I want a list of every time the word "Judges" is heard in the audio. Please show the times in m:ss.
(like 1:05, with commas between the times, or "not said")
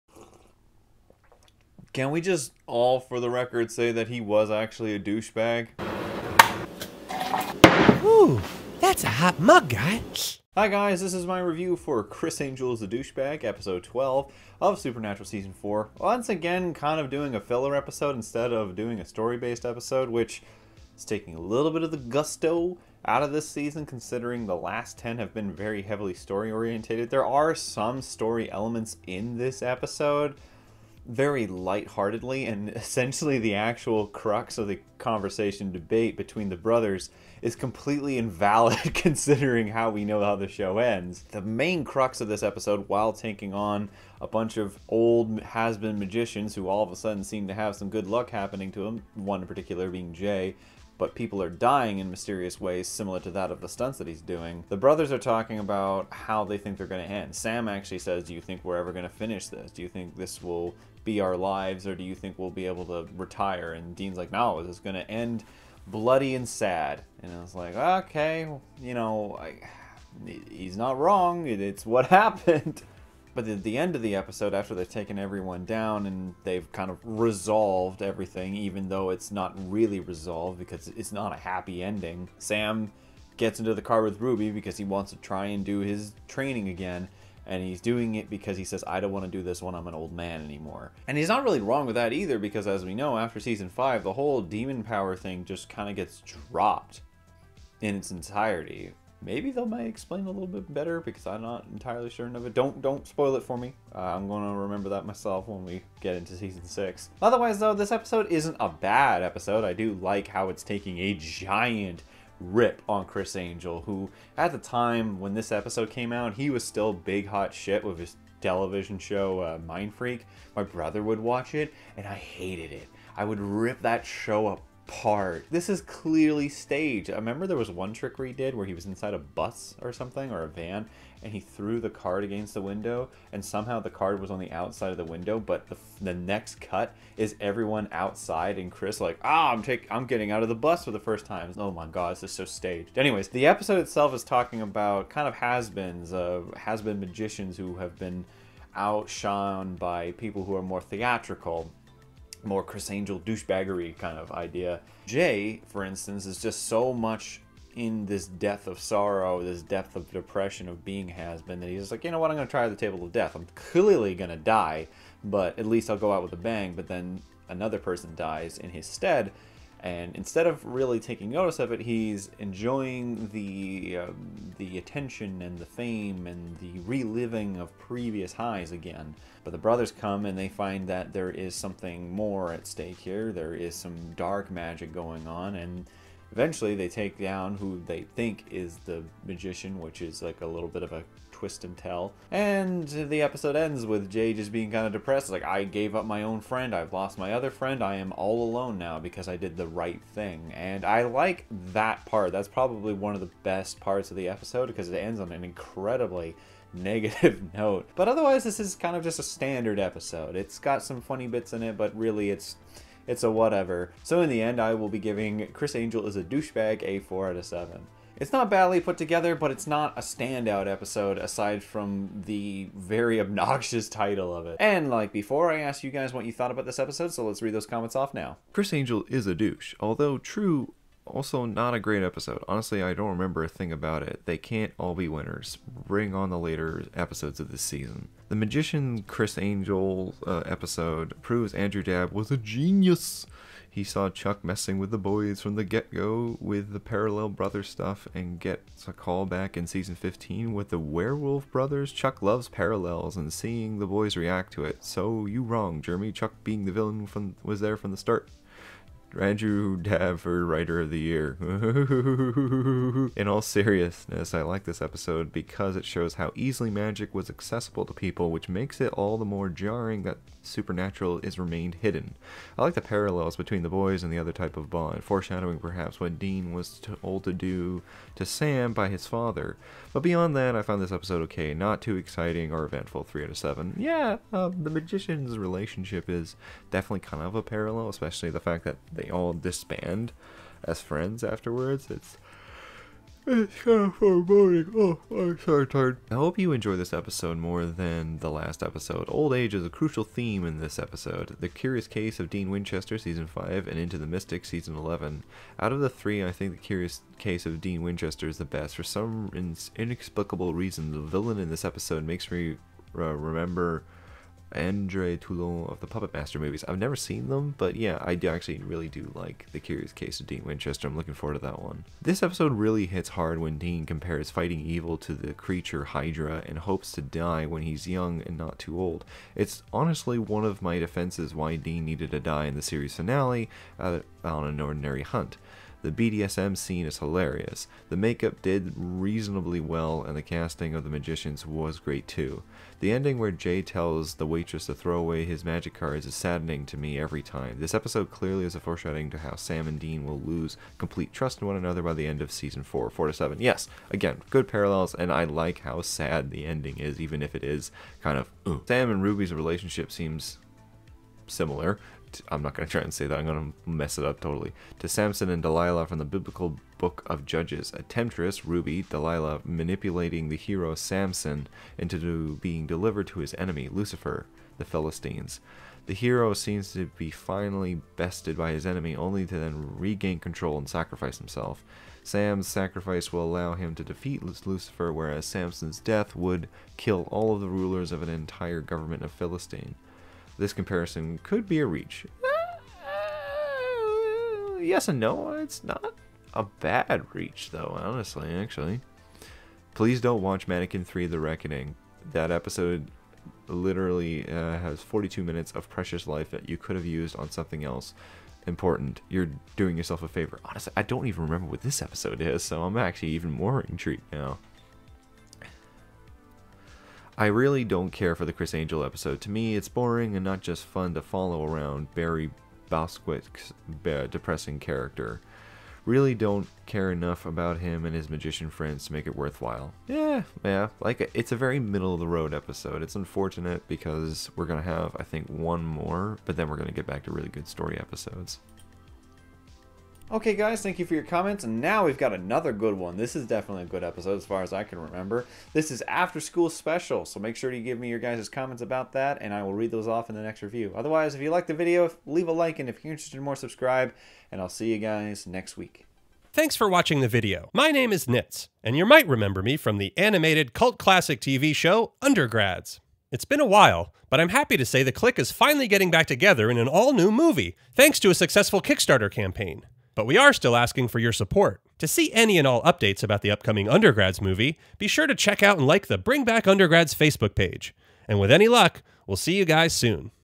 6:07.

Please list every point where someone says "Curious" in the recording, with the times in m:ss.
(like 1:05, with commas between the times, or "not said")
5:01, 5:06, 5:19.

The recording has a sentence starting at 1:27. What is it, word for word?
And he's doing it because he says, I don't want to do this when I'm an old man anymore.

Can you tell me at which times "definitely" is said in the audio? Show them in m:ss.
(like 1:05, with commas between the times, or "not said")
4:46, 7:23.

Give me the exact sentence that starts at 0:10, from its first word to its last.
Hi guys, this is my review for Criss Angel is a Douchebag, episode 12 of Supernatural Season 4.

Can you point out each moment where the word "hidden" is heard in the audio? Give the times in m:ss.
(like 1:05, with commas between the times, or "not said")
4:31.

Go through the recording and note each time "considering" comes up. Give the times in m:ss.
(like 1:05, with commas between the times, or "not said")
0:23, 0:38.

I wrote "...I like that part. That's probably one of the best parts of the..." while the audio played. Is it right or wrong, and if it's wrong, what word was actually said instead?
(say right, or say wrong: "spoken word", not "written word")
right.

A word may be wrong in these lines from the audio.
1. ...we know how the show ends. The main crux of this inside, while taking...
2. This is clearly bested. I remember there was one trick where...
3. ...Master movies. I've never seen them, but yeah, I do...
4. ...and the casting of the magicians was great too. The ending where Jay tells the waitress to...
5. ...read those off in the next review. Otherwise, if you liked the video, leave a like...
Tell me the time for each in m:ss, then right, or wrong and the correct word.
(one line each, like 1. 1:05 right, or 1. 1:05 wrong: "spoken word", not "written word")
1. 0:39 wrong: "episode", not "inside"
2. 2:05 wrong: "staged", not "bested"
3. 5:16 right
4. 5:40 right
5. 7:29 right.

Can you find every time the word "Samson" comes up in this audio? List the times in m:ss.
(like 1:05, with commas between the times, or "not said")
6:04, 6:10, 6:25.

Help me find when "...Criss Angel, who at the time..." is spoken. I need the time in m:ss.
1:53.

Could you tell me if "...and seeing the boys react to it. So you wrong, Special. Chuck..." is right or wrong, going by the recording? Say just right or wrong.
wrong.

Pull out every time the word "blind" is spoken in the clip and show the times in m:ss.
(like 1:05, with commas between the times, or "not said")
not said.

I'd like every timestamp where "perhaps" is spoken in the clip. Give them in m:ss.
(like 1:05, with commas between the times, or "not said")
4:35.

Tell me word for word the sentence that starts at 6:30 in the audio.
This comparison could be a reach.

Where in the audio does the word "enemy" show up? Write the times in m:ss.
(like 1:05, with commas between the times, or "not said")
6:13, 6:18.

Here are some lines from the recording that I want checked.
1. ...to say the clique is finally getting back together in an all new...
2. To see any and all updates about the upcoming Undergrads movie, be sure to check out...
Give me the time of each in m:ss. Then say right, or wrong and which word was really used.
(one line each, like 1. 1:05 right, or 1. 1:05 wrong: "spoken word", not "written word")
1. 7:44 right
2. 7:51 right.